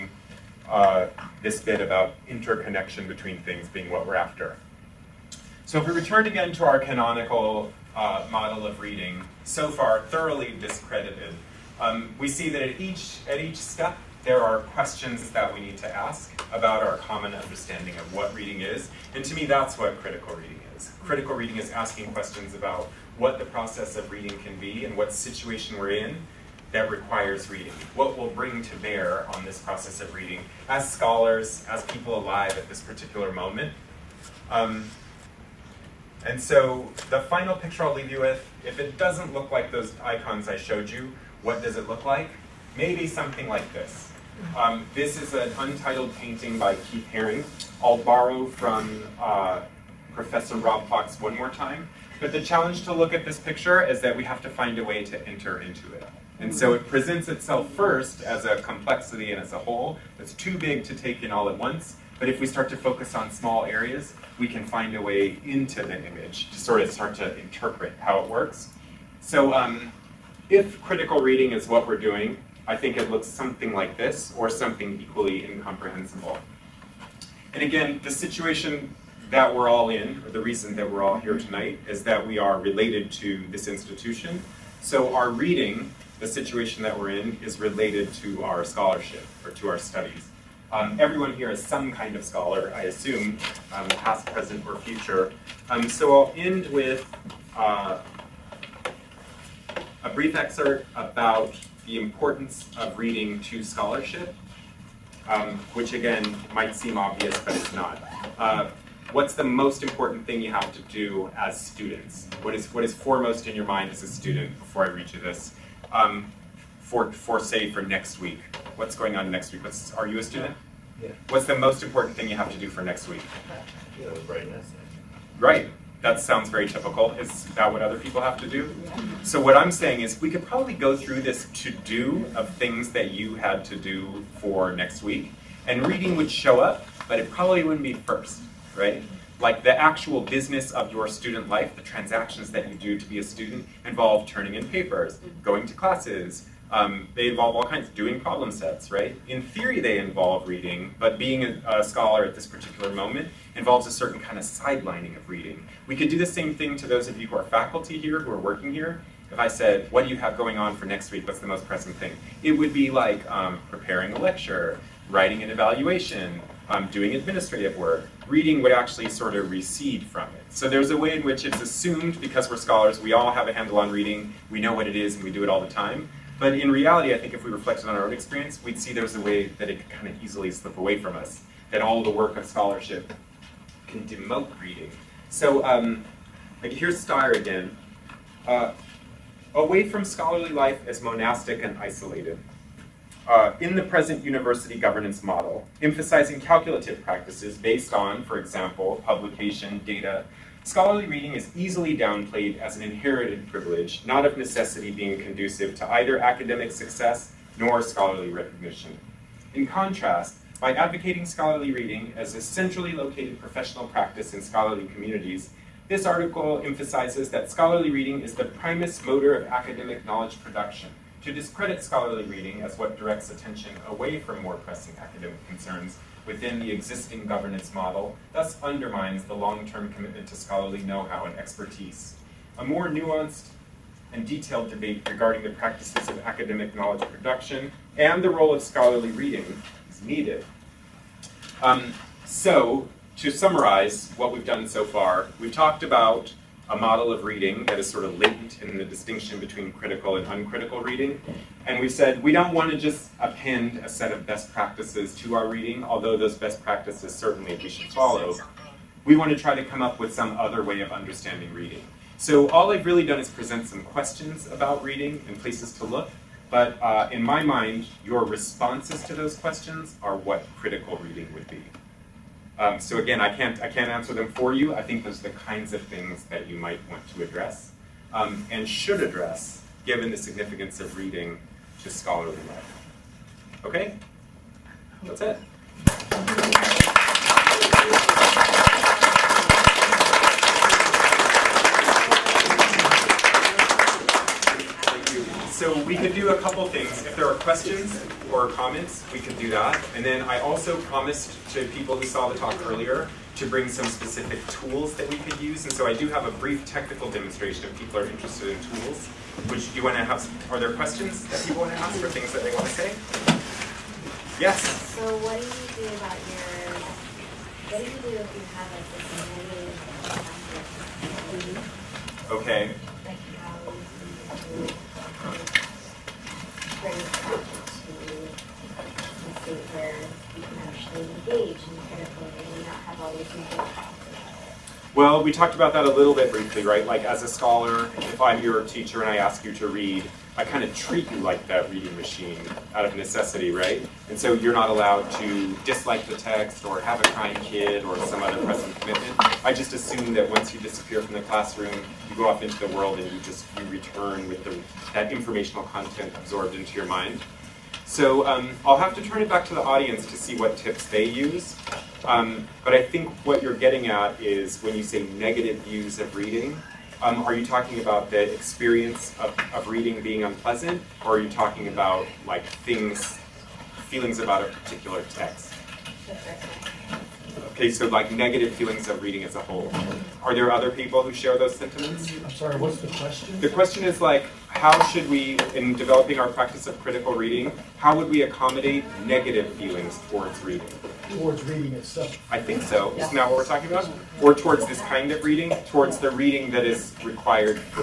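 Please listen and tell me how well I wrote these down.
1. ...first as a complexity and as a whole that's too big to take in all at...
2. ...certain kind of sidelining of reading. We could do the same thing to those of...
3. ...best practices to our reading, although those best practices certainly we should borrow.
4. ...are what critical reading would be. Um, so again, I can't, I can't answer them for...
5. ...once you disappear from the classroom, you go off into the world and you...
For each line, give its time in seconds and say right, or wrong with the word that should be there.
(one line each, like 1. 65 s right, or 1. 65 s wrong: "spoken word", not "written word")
1. 57 s right
2. 153 s right
3. 254 s wrong: "follow", not "borrow"
4. 270 s right
5. 350 s right.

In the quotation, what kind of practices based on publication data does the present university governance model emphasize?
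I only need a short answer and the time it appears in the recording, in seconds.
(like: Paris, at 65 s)
calculative practices, at 196 s.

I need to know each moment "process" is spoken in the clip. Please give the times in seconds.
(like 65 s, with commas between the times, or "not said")
23 s, 29 s.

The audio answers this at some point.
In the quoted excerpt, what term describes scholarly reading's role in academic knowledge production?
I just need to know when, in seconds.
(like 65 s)
218 s.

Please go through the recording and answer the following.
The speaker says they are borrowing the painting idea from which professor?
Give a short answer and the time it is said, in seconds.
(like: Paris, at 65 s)
Rob Fox, at 50 s.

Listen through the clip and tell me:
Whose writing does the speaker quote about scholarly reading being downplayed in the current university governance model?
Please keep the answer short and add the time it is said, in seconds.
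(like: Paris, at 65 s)
Steyer, at 187 s.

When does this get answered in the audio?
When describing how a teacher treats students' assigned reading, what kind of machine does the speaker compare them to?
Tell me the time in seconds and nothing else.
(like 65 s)
341 s.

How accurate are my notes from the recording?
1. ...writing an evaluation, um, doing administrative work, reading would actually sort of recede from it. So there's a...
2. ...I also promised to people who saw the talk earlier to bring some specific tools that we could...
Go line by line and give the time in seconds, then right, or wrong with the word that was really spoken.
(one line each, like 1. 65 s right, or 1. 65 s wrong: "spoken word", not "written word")
1. 165 s right
2. 300 s right.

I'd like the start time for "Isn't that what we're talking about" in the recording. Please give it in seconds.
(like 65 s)
392 s.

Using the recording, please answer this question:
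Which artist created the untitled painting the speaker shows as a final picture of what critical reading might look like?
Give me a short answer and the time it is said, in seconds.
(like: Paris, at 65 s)
Keith Haring, at 46 s.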